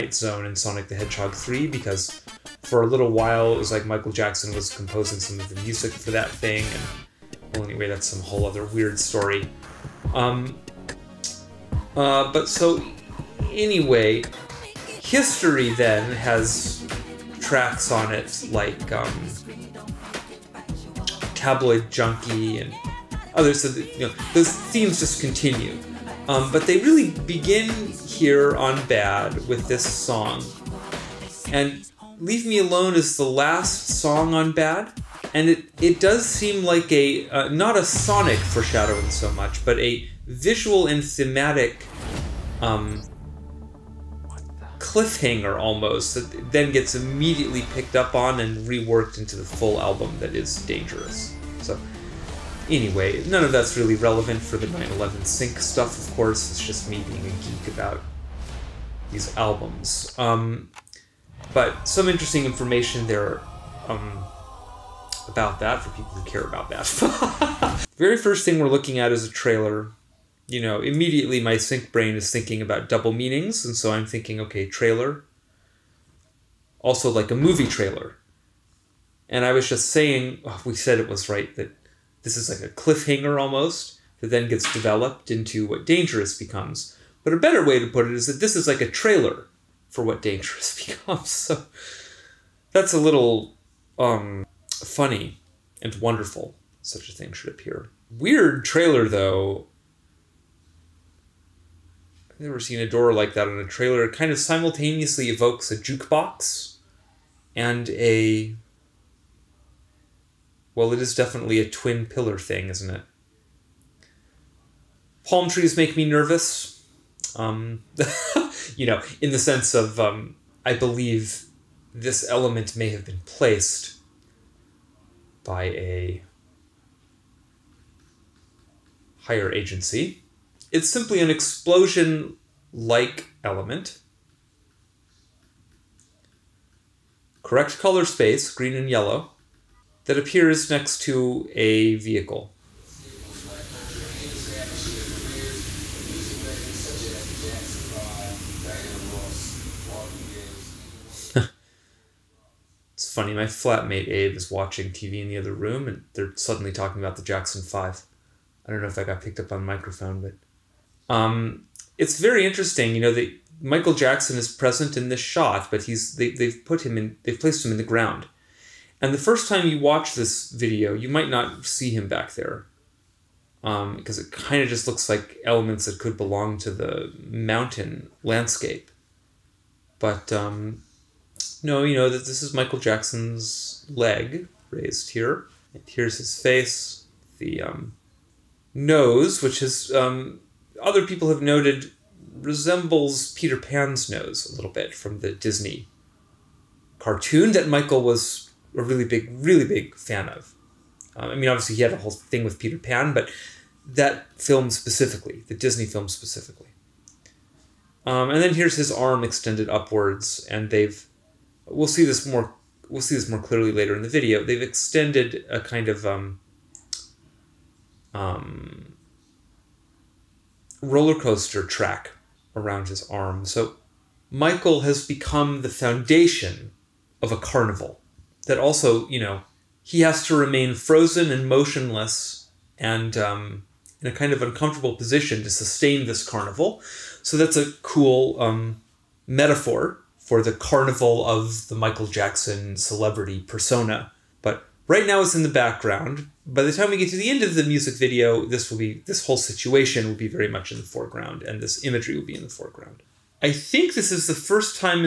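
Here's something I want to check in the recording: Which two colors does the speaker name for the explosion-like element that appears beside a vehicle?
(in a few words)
Green and yellow.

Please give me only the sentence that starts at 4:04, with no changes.
But right now it's in the background.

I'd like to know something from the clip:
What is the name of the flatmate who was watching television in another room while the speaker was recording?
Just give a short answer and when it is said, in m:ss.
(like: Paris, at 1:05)
Abe, at 2:34.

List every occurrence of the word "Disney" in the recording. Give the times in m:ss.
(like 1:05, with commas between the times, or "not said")
3:15, 3:25.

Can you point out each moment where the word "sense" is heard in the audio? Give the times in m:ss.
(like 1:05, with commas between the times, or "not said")
1:59.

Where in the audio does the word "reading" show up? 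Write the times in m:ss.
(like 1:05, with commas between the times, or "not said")
not said.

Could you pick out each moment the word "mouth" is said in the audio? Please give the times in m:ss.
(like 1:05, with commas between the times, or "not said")
not said.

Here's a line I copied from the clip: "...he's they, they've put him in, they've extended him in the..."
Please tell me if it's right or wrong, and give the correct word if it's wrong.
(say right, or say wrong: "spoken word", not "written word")
wrong: "placed", not "extended".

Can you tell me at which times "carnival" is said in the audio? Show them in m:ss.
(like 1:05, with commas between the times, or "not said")
3:47, 3:56, 4:00.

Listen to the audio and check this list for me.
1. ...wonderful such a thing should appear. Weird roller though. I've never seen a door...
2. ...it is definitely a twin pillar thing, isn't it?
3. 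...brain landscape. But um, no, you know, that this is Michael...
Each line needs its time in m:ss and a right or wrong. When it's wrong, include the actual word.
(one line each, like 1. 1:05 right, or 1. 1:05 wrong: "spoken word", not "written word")
1. 1:35 wrong: "trailer", not "roller"
2. 1:50 right
3. 2:57 wrong: "mountain", not "brain".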